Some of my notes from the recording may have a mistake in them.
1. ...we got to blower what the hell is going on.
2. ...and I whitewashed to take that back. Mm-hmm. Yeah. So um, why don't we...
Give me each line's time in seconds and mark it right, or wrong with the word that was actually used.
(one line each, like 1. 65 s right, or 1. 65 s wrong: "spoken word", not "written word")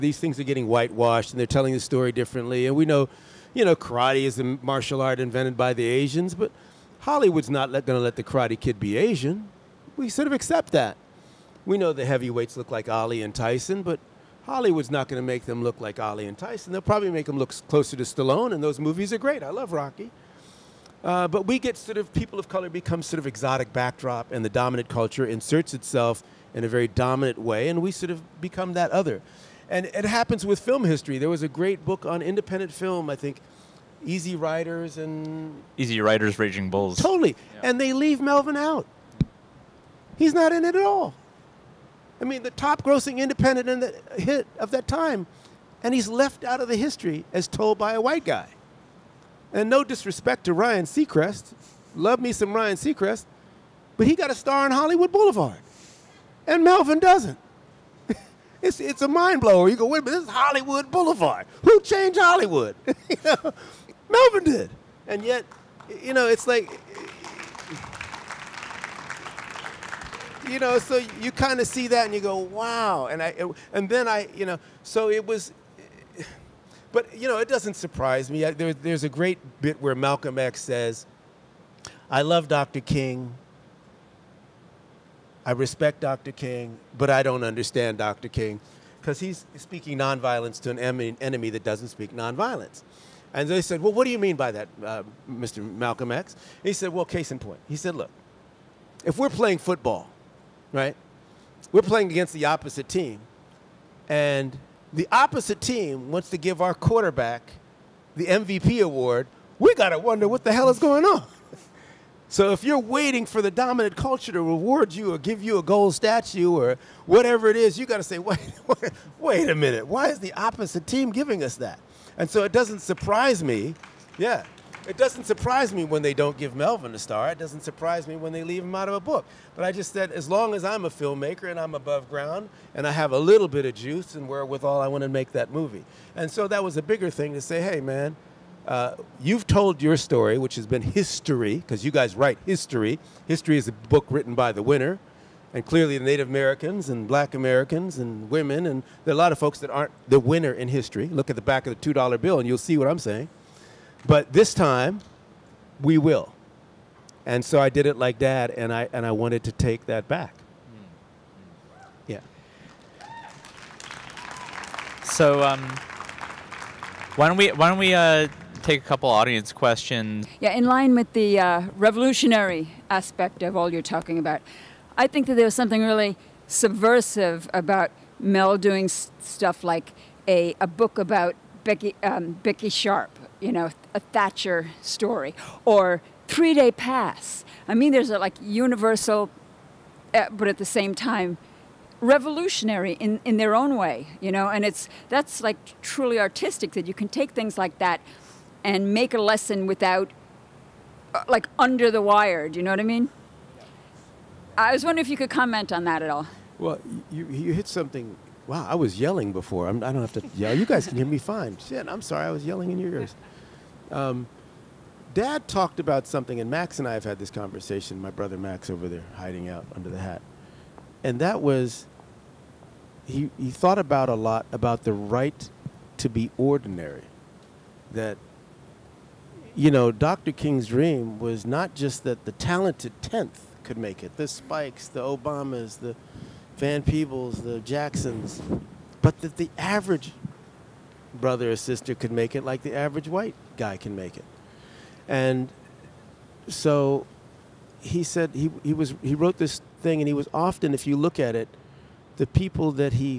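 1. 109 s wrong: "wonder", not "blower"
2. 158 s wrong: "wanted", not "whitewashed".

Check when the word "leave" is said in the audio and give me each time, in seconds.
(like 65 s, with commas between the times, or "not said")
37 s, 128 s.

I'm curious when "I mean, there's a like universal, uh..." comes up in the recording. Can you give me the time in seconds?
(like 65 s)
187 s.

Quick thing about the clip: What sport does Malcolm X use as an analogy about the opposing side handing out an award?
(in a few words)
Football.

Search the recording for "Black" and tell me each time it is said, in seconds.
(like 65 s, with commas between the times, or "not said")
147 s.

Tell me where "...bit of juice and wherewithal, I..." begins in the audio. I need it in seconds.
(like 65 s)
133 s.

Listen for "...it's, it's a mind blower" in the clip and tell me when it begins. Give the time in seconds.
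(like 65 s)
58 s.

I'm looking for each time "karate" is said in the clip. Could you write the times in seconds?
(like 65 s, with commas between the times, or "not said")
3 s, 8 s.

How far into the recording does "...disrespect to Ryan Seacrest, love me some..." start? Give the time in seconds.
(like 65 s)
49 s.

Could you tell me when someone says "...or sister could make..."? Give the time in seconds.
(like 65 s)
241 s.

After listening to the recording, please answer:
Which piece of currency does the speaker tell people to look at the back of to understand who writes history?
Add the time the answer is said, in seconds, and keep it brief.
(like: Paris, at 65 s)
$2 bill, at 151 s.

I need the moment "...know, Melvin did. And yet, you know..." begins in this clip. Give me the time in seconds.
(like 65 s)
63 s.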